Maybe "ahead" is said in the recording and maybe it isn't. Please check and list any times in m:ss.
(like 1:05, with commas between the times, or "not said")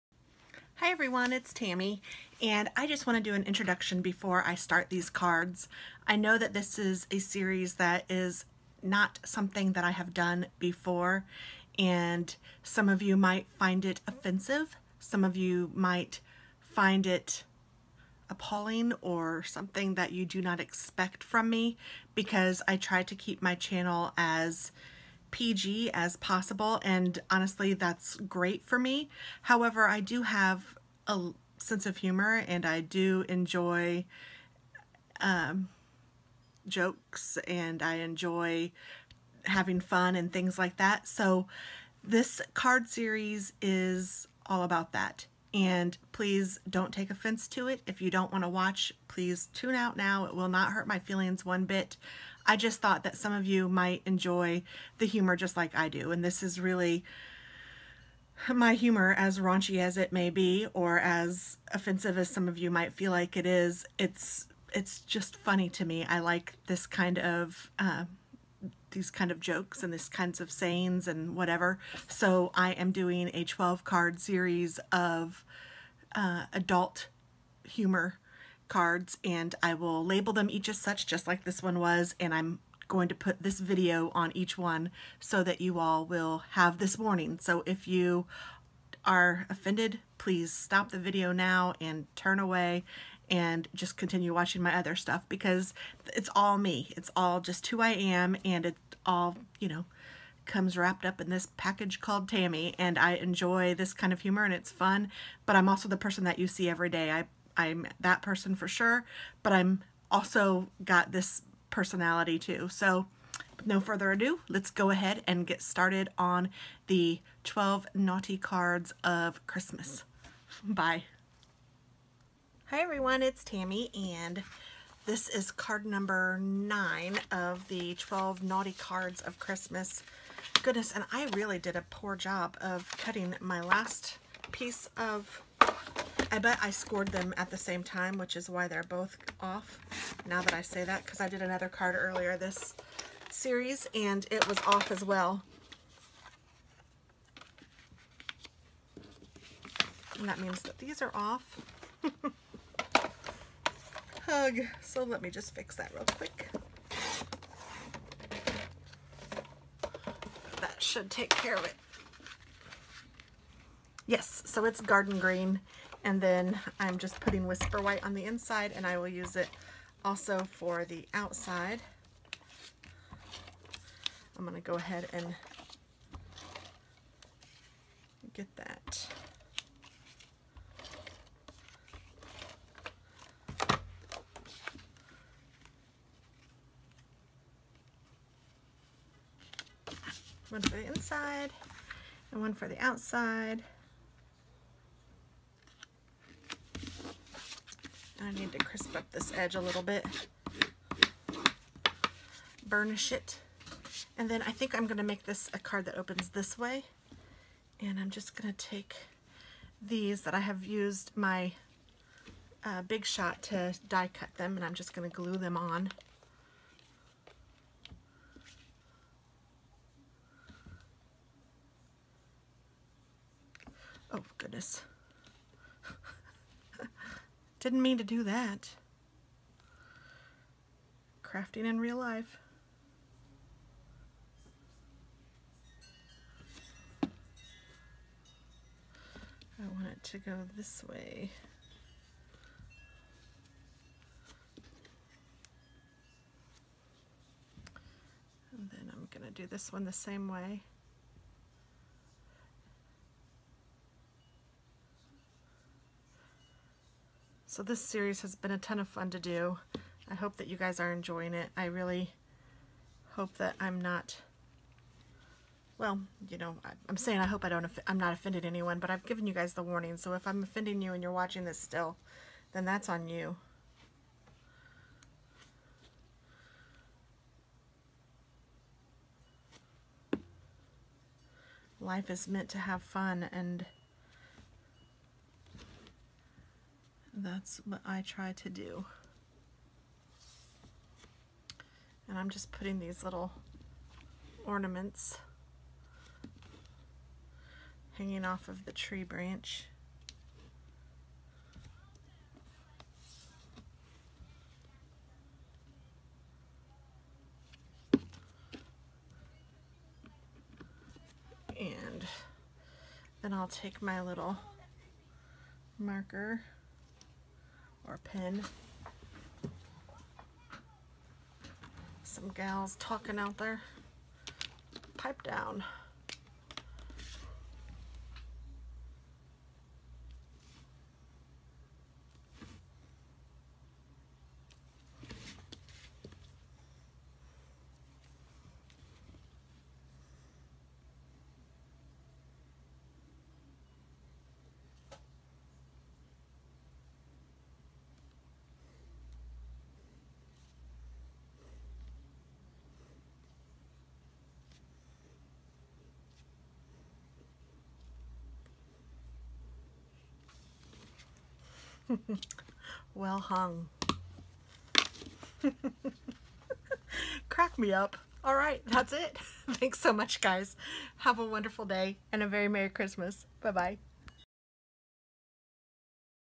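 1:54, 2:54.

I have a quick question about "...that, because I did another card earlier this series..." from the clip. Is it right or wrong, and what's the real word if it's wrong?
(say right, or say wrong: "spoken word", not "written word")
right.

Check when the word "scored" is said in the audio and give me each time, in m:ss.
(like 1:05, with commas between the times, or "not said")
2:16.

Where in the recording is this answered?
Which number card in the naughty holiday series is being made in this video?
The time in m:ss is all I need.
2:05.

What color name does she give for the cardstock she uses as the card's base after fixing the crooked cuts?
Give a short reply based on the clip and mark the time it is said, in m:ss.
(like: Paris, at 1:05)
Garden Green, at 2:44.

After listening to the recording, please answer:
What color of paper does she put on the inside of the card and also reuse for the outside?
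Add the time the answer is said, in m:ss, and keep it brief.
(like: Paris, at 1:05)
Whisper White, at 2:47.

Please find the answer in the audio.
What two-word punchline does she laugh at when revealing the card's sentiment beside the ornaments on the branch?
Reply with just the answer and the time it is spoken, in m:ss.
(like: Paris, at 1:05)
well hung, at 6:02.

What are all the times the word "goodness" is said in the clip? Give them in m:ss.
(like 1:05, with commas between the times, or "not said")
2:10, 3:44.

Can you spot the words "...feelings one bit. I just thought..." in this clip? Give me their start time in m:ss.
0:50.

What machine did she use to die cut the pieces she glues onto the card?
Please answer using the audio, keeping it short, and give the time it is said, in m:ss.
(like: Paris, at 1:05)
Big Shot, at 3:32.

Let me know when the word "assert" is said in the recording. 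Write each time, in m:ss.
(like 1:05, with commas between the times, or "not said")
not said.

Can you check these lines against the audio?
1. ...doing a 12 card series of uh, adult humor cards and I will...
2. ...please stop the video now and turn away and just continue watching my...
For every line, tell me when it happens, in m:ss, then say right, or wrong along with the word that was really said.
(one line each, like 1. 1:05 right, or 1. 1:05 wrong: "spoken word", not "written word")
1. 1:12 right
2. 1:30 right.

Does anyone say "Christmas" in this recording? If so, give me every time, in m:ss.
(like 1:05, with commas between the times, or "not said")
1:59, 2:09, 6:12.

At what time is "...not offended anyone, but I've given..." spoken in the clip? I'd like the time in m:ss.
4:27.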